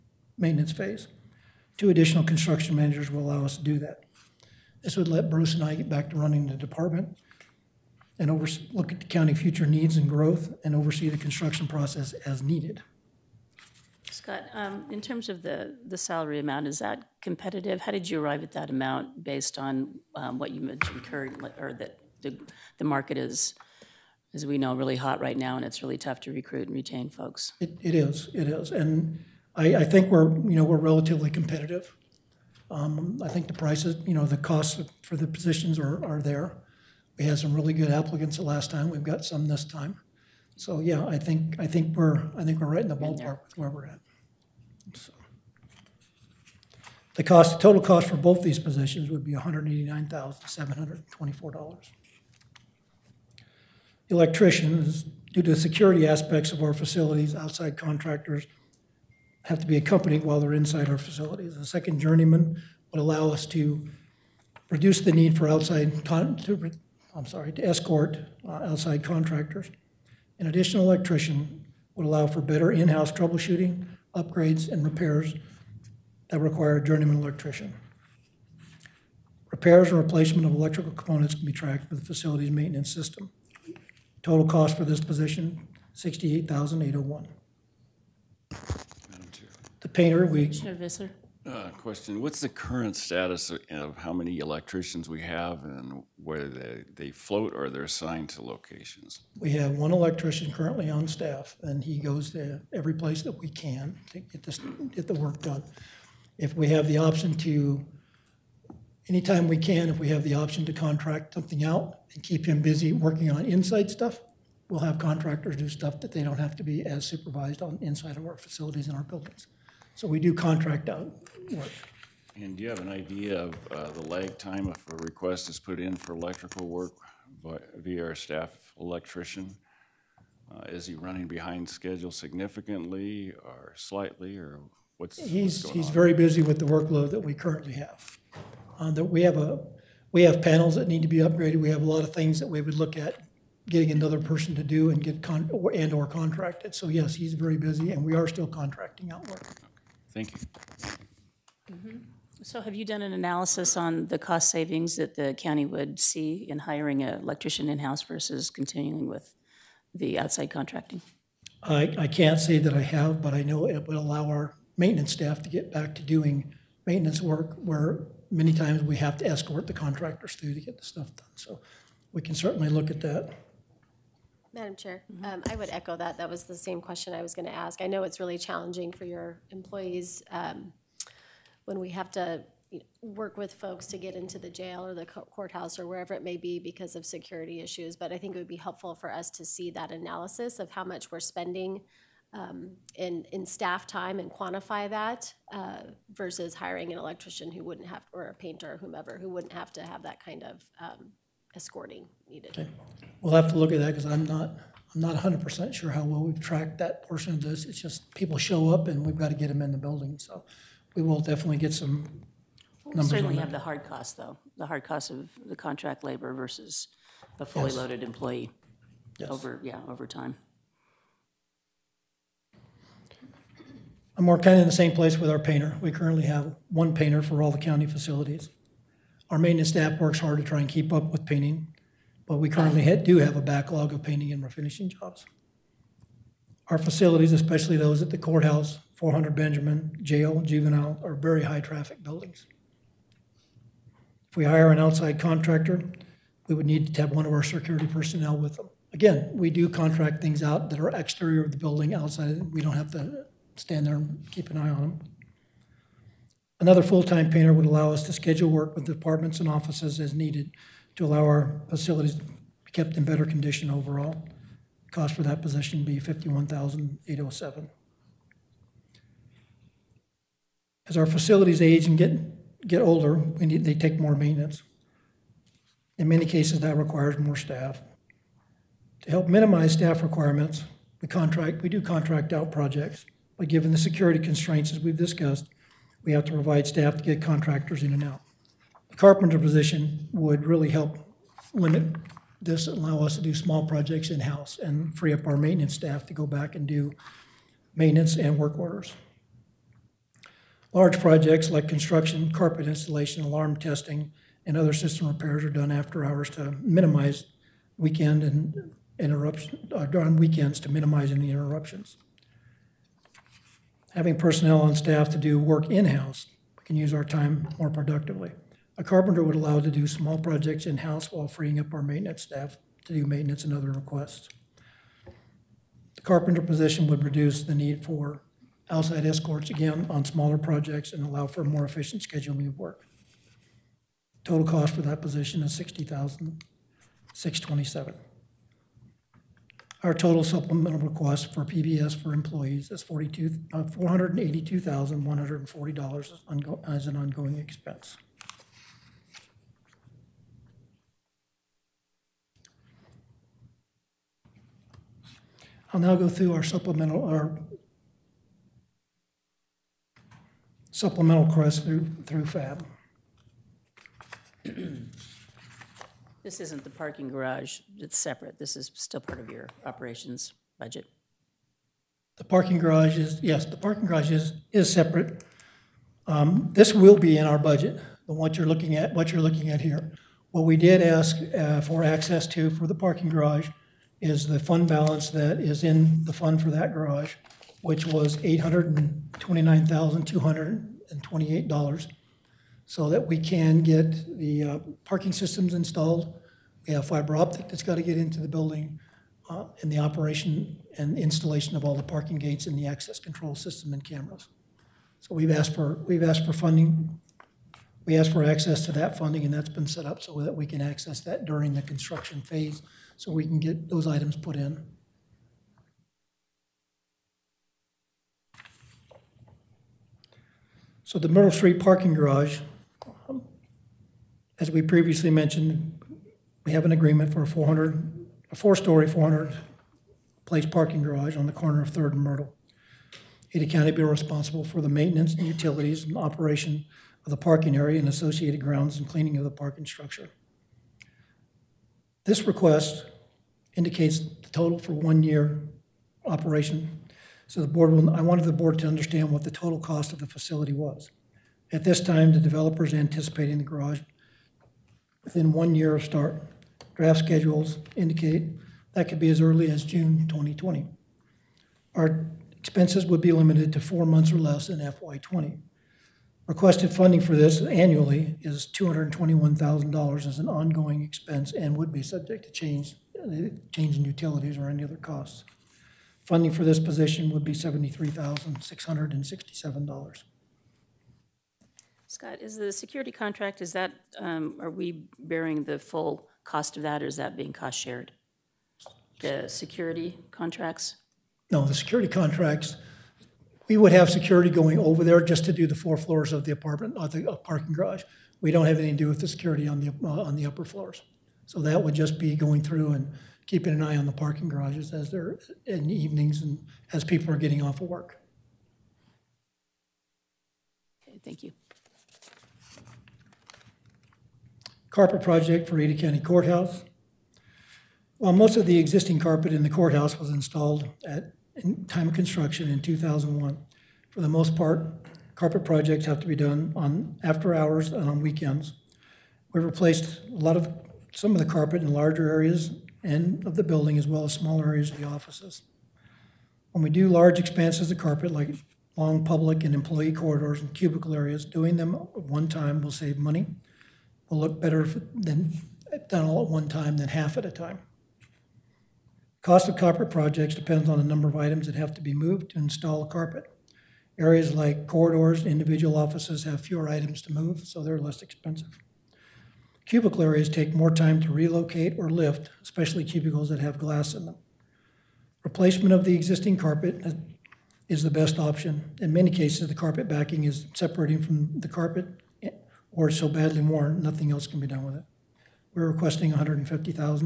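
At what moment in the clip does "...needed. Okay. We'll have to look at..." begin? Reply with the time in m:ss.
3:22.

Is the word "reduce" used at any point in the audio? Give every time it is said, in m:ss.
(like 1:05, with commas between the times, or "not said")
1:04, 5:27.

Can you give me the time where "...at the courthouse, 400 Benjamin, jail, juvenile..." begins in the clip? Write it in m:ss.
3:58.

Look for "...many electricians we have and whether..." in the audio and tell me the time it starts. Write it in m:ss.
1:34.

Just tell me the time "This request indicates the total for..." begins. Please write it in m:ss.
7:22.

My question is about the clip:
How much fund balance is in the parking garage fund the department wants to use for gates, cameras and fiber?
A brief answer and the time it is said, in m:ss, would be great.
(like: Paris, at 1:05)
$829,228, at 6:28.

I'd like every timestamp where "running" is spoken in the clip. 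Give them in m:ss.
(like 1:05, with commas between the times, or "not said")
0:06, 2:10.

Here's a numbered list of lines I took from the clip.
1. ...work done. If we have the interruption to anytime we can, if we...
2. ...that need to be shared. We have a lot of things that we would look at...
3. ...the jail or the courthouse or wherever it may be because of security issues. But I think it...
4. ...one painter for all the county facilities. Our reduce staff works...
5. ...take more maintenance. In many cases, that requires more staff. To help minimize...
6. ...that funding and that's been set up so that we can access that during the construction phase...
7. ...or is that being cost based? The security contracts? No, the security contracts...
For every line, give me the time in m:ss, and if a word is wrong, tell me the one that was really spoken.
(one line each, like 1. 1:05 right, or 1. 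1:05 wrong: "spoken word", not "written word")
1. 1:45 wrong: "option", not "interruption"
2. 2:20 wrong: "upgraded", not "shared"
3. 3:04 right
4. 3:46 wrong: "maintenance", not "reduce"
5. 4:33 right
6. 6:48 right
7. 8:06 wrong: "shared", not "based".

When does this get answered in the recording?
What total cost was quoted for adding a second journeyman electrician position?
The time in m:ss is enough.
1:25.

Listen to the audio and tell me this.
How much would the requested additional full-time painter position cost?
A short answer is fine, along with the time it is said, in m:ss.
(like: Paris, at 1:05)
$51,807, at 4:25.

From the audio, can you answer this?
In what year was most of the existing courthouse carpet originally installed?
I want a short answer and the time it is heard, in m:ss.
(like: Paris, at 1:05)
2001, at 8:42.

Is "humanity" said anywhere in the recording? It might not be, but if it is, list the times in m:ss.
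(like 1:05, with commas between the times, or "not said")
not said.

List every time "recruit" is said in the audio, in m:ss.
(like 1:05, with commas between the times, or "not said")
0:26.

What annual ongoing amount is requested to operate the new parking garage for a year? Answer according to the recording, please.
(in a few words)
$221,000.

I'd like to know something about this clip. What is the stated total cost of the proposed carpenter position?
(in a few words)
$60,627.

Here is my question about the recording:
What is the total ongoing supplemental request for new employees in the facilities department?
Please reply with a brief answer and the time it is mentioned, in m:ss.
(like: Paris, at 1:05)
$482,140, at 5:42.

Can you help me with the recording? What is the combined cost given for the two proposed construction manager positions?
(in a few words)
$189,724.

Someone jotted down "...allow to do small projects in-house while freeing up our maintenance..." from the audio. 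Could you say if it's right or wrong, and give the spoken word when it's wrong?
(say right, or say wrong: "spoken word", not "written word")
right.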